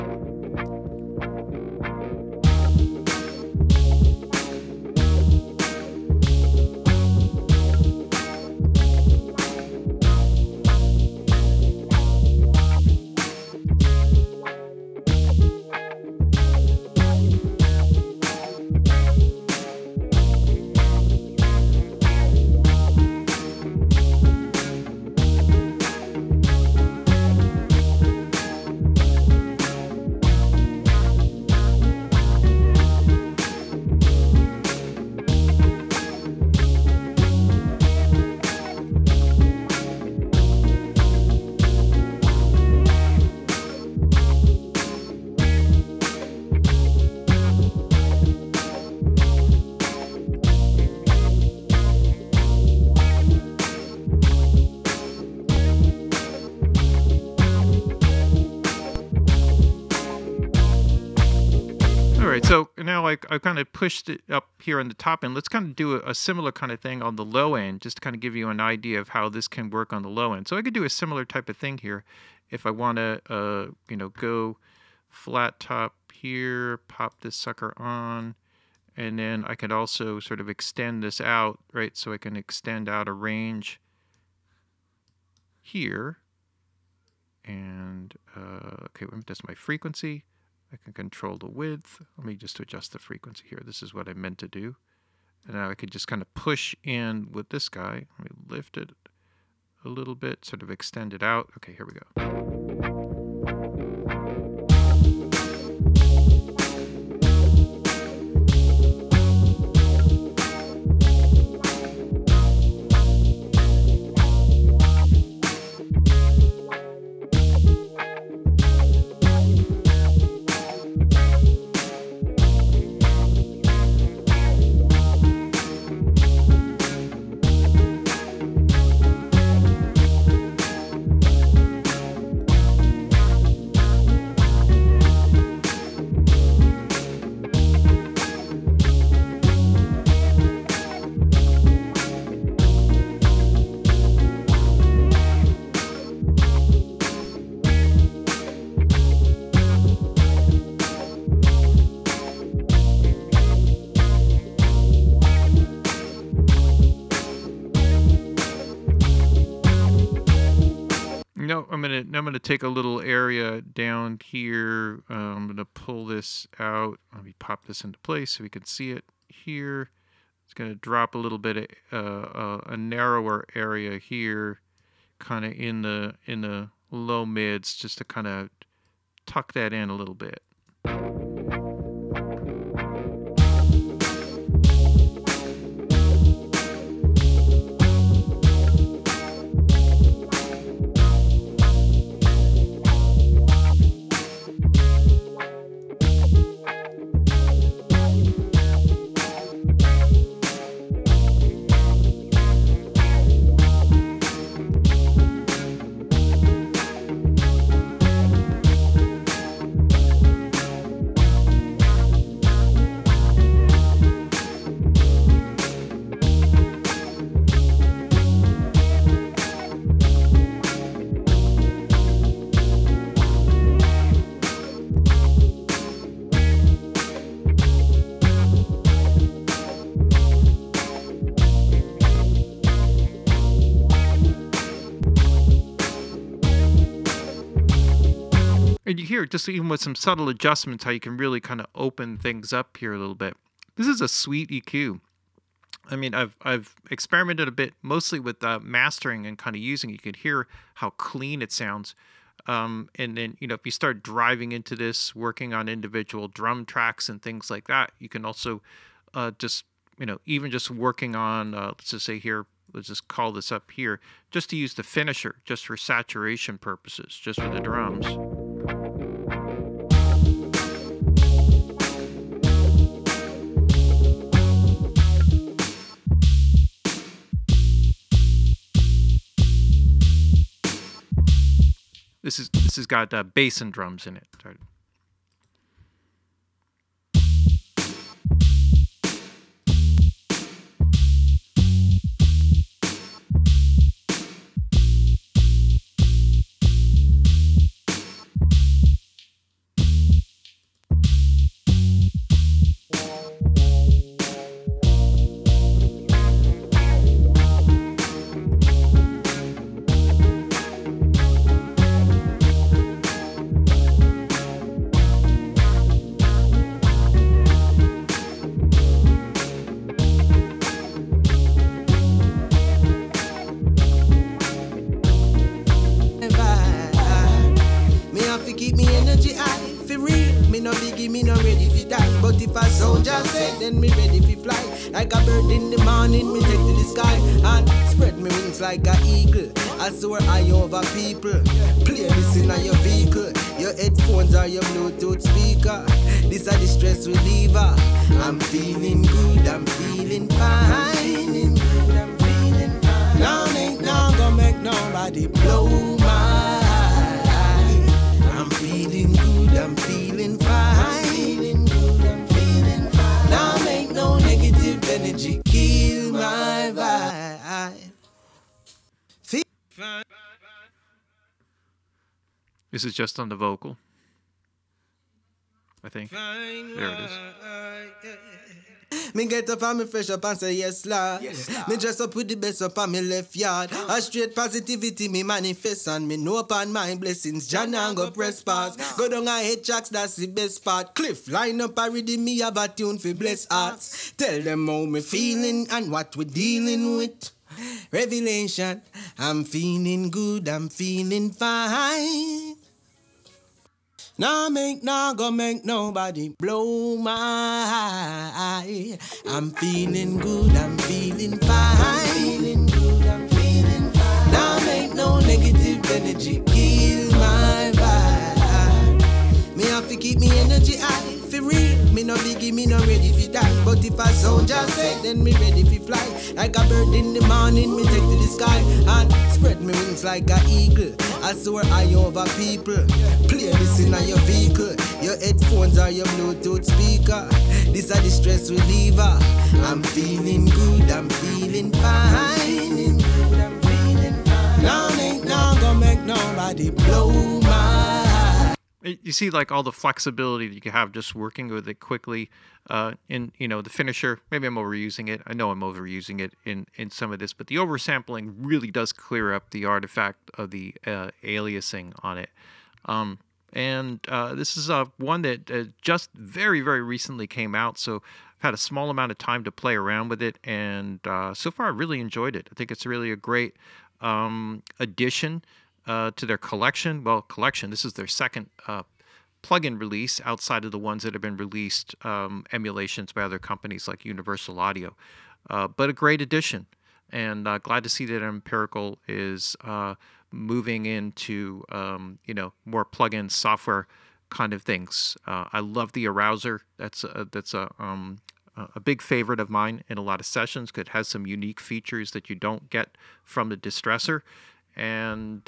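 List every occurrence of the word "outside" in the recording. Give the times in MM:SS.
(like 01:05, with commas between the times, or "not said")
08:00.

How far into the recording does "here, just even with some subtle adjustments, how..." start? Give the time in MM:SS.
03:59.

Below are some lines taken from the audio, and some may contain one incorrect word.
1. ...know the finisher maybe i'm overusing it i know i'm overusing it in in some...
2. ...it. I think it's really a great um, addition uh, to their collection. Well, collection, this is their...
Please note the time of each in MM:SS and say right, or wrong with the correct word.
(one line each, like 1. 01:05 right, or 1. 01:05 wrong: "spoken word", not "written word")
1. 07:33 right
2. 07:52 right.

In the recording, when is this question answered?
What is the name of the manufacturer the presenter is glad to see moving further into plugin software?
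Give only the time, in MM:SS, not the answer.
08:08.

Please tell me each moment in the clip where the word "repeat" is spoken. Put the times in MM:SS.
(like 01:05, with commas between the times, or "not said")
not said.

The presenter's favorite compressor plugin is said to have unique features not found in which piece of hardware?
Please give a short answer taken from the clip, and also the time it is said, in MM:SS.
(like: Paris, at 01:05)
the Distressor, at 08:23.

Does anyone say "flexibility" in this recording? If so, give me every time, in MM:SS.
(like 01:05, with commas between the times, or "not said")
07:29.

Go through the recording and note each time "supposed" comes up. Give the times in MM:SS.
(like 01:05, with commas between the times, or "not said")
not said.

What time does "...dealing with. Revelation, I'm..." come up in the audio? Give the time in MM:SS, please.
06:36.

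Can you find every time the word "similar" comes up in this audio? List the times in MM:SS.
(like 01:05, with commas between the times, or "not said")
01:06, 01:10.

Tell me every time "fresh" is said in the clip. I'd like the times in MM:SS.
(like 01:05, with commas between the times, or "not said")
06:19.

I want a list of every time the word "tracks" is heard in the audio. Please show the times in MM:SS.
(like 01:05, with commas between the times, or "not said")
04:16, 06:29.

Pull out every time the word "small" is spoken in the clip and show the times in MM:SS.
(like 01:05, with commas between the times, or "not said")
07:48.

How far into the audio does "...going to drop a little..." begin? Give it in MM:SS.
02:50.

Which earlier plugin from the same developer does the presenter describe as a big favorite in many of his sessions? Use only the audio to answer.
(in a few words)
Arousor.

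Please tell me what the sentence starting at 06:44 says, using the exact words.
Nah make, nah go make nobody blow my eye.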